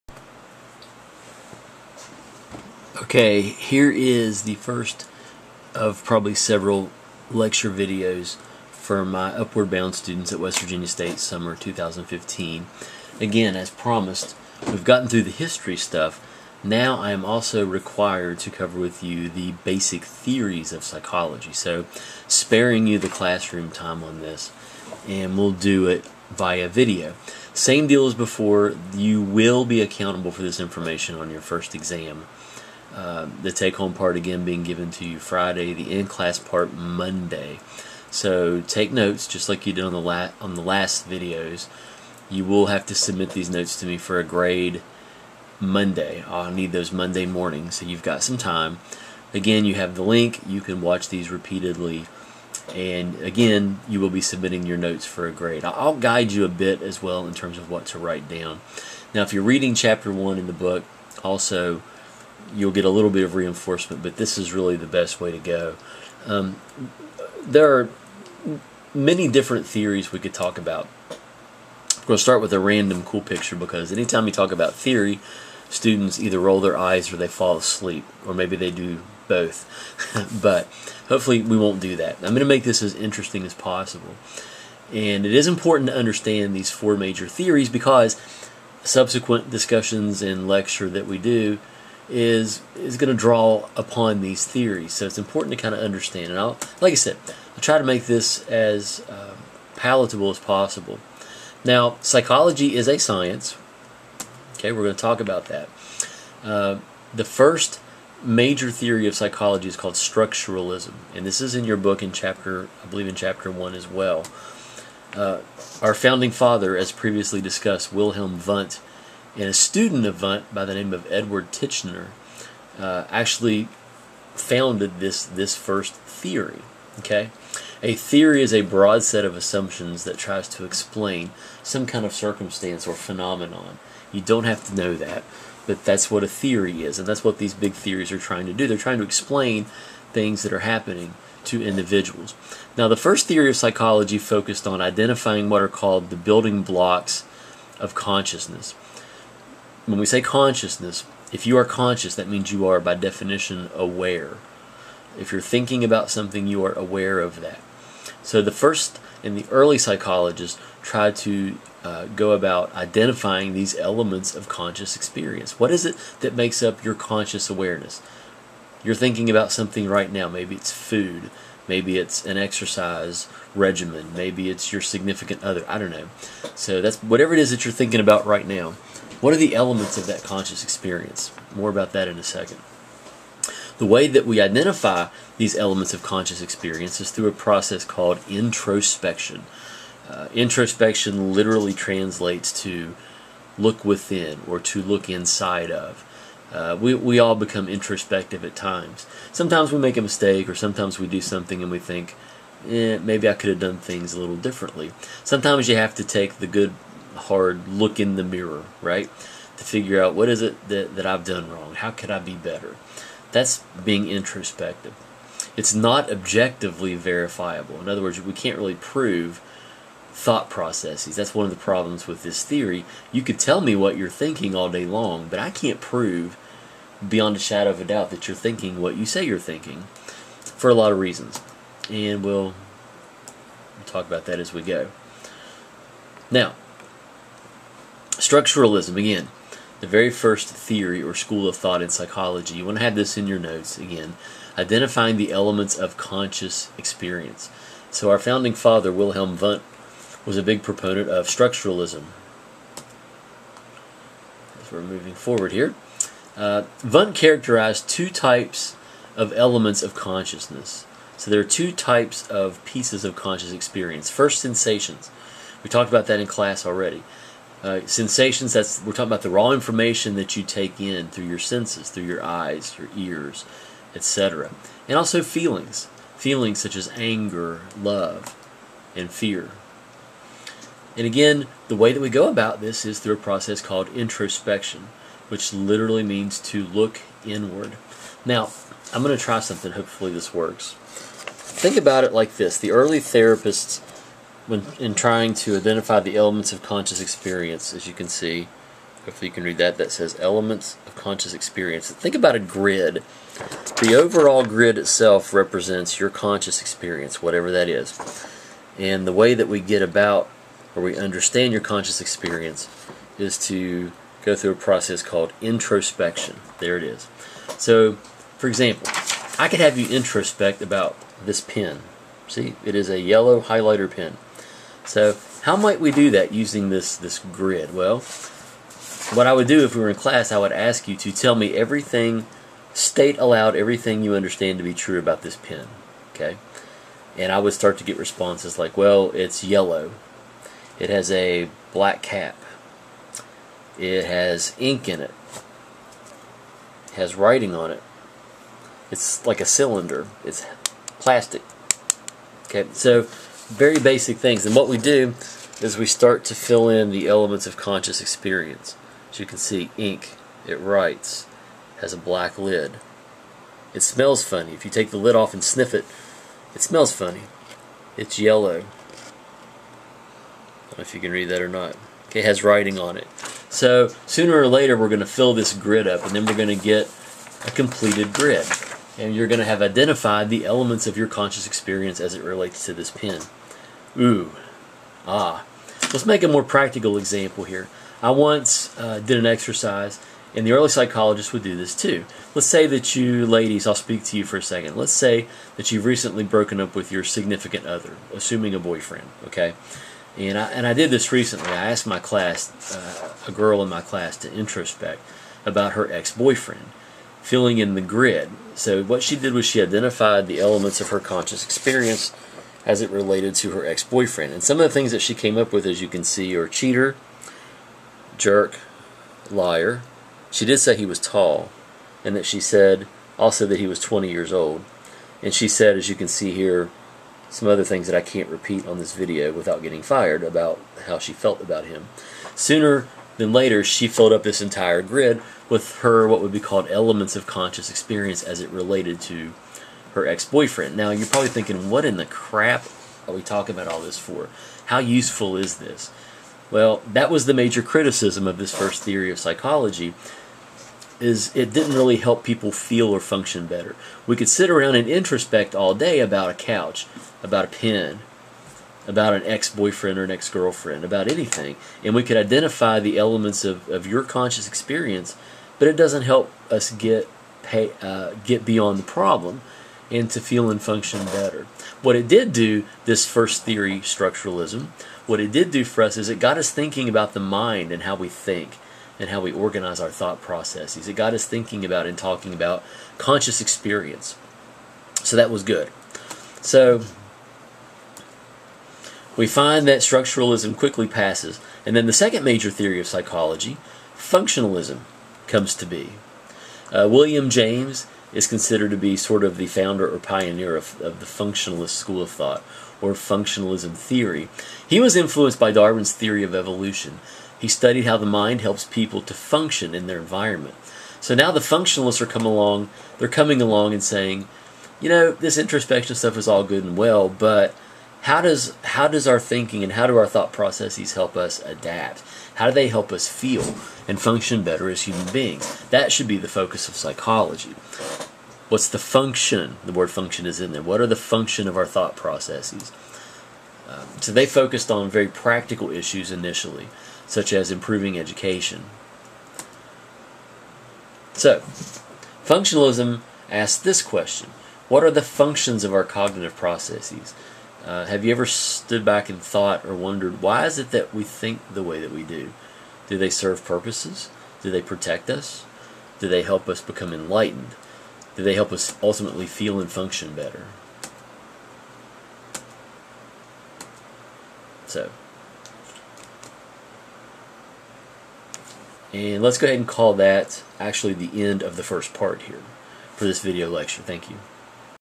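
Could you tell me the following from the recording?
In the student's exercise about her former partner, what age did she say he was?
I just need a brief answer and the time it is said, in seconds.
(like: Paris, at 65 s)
20, at 423 s.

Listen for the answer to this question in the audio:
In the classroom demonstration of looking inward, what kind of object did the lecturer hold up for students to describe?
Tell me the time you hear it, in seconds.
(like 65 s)
322 s.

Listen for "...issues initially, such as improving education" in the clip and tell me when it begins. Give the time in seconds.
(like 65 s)
535 s.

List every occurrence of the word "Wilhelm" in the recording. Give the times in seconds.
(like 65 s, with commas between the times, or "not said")
117 s, 248 s.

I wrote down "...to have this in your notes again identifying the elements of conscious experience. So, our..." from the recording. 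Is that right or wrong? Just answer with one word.
right.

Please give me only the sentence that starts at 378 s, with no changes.
And you're going to have identified the elements of your conscious experience as it relates to this pen.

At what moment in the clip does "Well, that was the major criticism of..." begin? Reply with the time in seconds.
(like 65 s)
446 s.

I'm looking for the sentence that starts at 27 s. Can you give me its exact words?
Same deal as before, you will be accountable for this information on your first exam.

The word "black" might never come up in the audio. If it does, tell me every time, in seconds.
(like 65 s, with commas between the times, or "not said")
341 s, 361 s.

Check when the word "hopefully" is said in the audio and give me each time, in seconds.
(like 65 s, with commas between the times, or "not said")
81 s, 289 s, 299 s.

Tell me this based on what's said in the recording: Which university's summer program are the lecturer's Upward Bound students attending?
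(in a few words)
West Virginia State.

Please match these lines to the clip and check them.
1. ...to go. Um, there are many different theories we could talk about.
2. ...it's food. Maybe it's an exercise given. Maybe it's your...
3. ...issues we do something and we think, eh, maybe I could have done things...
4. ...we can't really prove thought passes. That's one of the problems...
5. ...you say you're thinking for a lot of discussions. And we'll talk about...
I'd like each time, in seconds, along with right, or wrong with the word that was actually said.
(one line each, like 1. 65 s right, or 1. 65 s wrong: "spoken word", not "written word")
1. 65 s right
2. 170 s wrong: "regimen", not "given"
3. 200 s wrong: "sometimes", not "issues"
4. 218 s wrong: "processes", not "passes"
5. 228 s wrong: "reasons", not "discussions".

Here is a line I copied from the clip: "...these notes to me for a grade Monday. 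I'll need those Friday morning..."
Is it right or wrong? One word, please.
wrong.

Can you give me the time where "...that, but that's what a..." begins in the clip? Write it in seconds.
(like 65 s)
134 s.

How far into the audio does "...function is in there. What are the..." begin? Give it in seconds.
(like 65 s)
529 s.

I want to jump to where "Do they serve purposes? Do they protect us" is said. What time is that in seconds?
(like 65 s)
552 s.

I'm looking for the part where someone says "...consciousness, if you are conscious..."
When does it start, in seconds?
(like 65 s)
150 s.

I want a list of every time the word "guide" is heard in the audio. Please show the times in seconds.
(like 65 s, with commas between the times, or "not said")
55 s.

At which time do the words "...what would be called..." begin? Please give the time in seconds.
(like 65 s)
436 s.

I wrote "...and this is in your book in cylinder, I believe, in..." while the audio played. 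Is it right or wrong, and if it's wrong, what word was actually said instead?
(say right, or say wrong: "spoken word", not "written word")
wrong: "chapter", not "cylinder".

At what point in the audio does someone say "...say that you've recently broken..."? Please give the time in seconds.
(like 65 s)
394 s.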